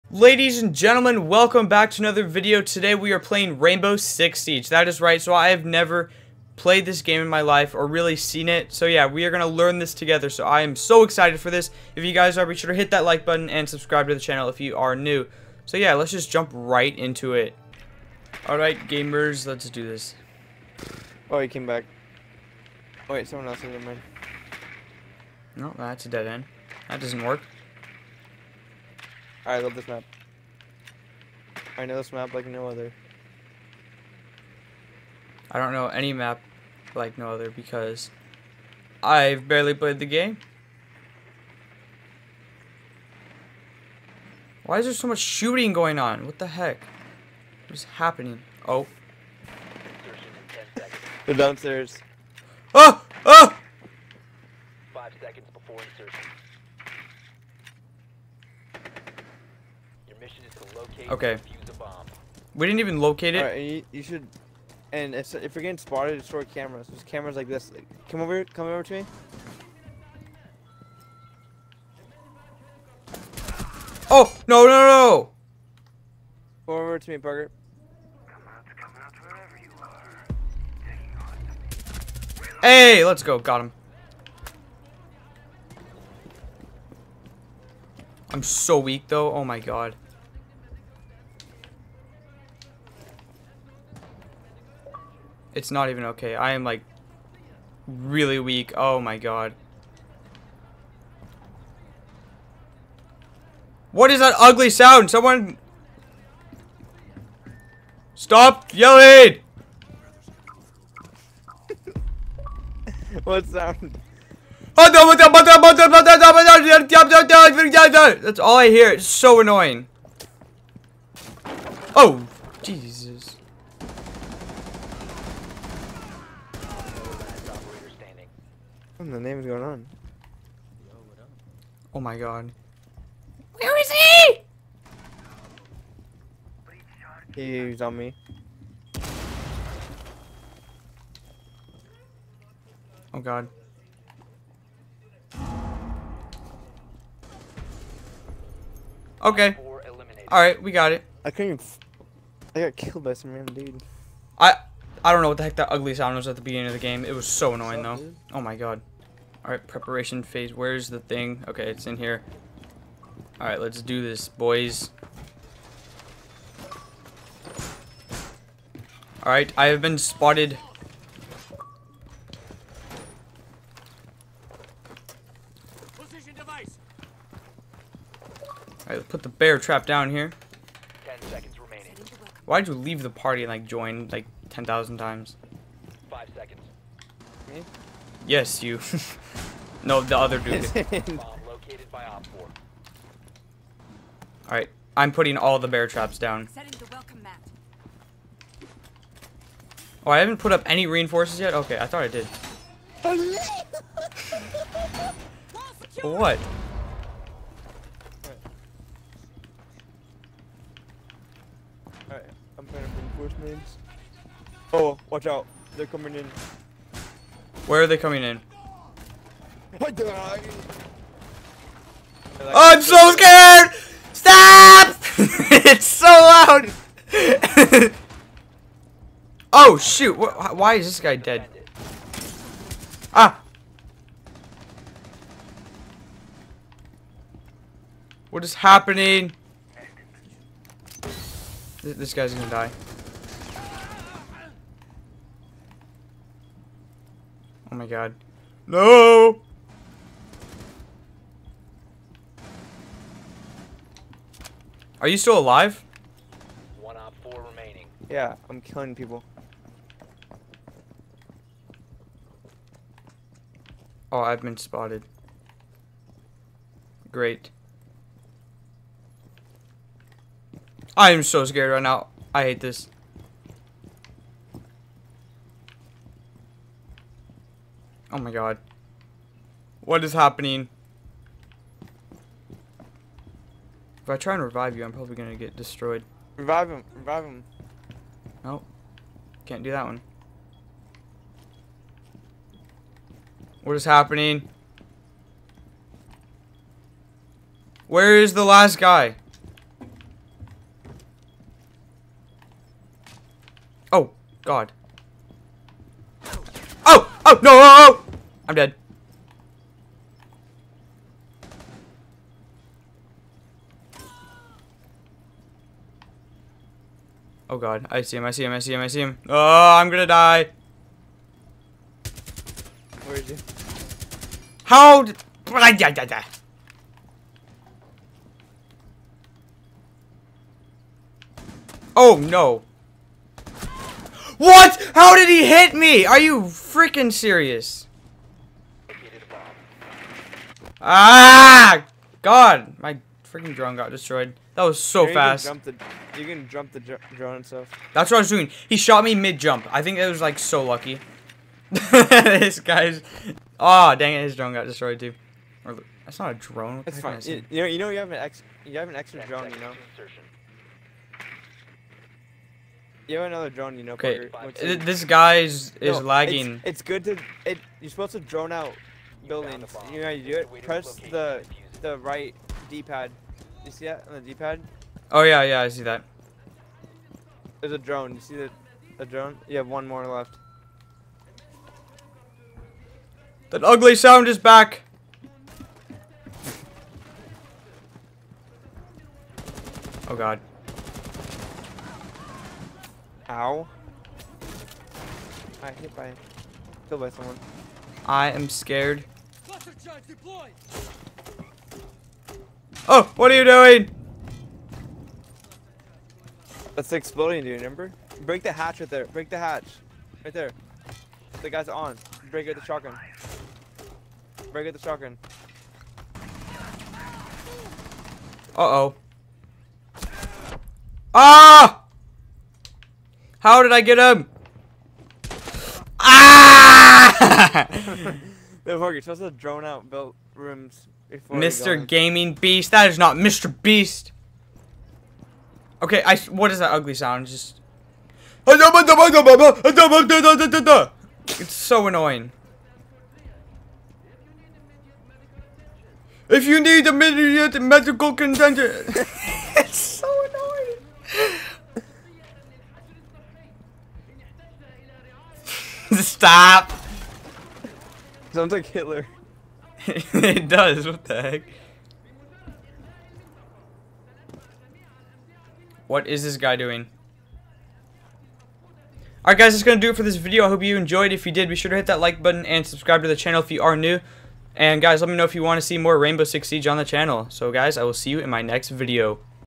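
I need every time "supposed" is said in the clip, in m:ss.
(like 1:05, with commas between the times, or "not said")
6:07, 7:09.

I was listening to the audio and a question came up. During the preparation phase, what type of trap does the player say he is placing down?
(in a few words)
bear trap.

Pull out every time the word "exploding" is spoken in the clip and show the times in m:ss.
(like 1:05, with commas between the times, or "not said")
6:46.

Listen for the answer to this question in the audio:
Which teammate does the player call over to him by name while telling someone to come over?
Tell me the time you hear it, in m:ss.
1:17.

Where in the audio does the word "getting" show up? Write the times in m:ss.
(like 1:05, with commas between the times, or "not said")
1:05.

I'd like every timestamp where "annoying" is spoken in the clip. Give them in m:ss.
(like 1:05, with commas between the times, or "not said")
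1:59, 2:37, 7:21, 7:30.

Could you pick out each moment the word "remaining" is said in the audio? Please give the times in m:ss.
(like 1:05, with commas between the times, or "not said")
3:01, 4:17.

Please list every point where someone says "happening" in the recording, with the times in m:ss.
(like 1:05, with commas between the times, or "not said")
0:47, 3:58, 4:40, 4:53.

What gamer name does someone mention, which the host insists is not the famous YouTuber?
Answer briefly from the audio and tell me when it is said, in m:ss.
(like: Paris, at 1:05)
Mr. Gaming Beast, at 7:11.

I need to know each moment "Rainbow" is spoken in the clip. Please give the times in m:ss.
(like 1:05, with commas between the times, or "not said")
0:03, 7:55.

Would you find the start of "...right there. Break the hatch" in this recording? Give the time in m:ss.
6:48.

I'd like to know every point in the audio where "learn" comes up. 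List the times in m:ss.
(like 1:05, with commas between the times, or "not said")
0:09.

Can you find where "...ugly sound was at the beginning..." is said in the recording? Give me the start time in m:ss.
2:35.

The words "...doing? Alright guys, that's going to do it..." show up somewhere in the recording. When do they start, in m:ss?
7:46.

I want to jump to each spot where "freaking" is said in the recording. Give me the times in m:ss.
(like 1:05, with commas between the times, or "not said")
5:36, 5:43.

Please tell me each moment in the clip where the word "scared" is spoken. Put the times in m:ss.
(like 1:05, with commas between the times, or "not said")
3:43, 4:31, 6:38.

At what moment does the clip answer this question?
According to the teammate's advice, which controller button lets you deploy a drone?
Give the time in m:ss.
6:11.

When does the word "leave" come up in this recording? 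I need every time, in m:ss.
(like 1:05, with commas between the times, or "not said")
3:02.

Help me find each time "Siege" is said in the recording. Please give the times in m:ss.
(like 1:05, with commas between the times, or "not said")
0:04, 7:56.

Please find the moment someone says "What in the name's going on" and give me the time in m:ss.
2:09.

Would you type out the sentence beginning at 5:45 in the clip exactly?
Can the, you can jump the drone and stuff.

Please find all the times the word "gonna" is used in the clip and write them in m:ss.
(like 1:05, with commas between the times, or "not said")
4:02, 4:45, 5:19.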